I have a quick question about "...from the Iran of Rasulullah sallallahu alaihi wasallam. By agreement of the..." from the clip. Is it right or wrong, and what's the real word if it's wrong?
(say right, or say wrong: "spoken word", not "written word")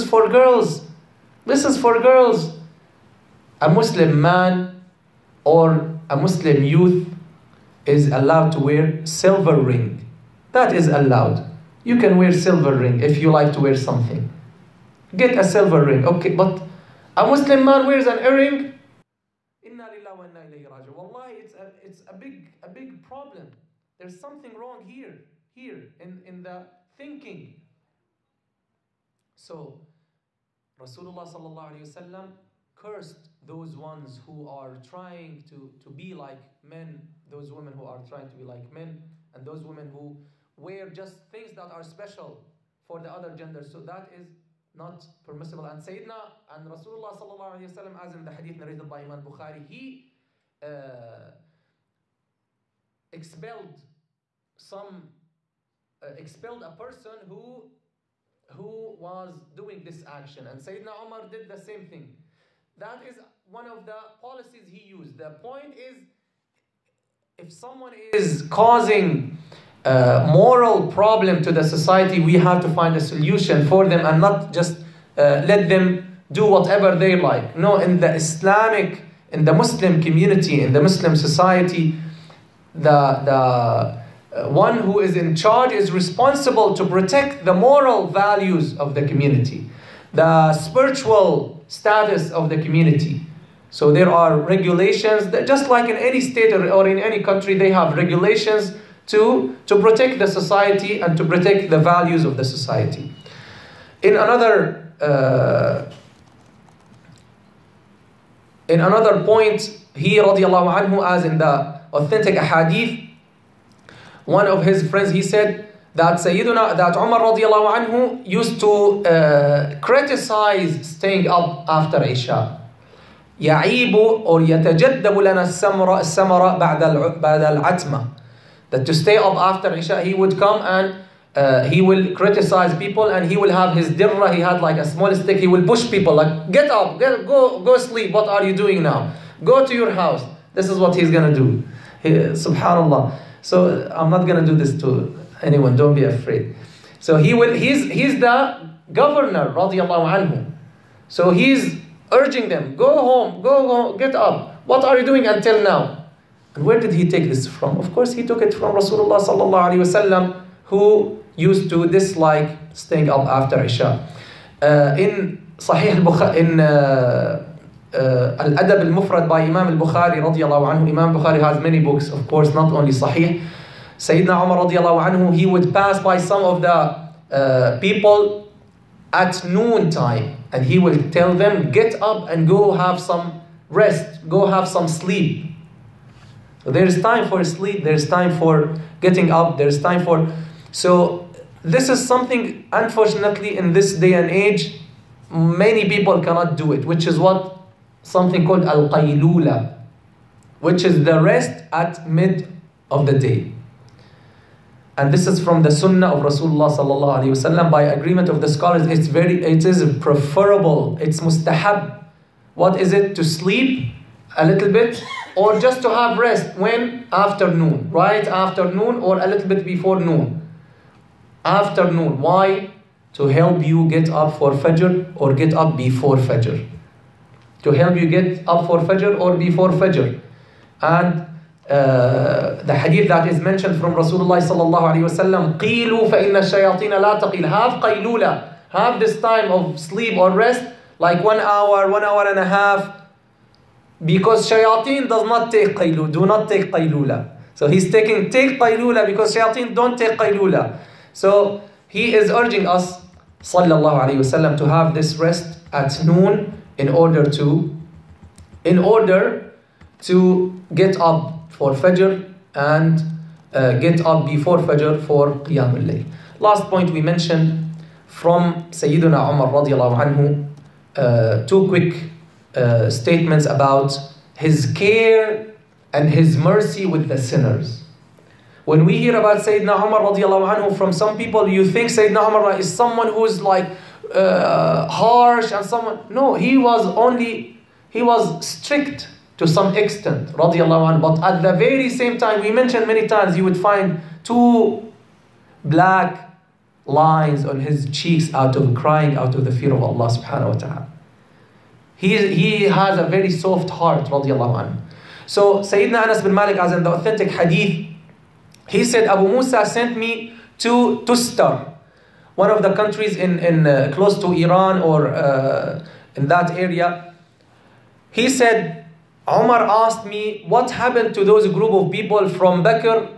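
wrong: "Sunnah", not "Iran".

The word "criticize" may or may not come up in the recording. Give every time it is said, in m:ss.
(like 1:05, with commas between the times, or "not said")
1:59, 2:12.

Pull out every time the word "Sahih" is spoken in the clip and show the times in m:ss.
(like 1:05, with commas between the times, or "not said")
2:45, 2:52.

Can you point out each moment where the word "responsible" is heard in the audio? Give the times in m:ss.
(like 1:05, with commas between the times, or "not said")
1:25.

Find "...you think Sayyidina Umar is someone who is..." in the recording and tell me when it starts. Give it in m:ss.
4:41.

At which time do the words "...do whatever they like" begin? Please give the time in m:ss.
1:16.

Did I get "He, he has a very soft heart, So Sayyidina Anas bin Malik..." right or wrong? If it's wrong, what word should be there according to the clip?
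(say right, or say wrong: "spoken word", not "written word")
right.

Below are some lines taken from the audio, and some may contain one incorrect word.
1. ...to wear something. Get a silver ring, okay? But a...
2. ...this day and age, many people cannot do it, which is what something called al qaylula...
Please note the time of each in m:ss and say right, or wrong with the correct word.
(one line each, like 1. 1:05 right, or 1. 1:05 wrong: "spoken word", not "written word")
1. 0:13 right
2. 3:13 right.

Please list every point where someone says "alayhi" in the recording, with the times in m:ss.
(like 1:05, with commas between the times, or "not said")
0:31, 0:47, 4:14.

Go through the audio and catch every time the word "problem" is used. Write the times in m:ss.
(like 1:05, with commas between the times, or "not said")
0:23, 1:10.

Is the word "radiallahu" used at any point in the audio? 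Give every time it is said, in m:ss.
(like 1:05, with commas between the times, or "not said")
1:50, 1:57, 2:29, 2:50, 2:54, 4:29.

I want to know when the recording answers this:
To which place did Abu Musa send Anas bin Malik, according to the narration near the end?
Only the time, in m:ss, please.
5:11.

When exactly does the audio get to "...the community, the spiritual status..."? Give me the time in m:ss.
1:28.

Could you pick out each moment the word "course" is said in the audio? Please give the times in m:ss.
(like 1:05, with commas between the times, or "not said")
2:37, 2:52.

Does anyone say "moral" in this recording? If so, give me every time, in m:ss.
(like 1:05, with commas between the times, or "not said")
1:10, 1:27.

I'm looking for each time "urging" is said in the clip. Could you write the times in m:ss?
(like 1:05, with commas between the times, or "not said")
2:32, 4:12.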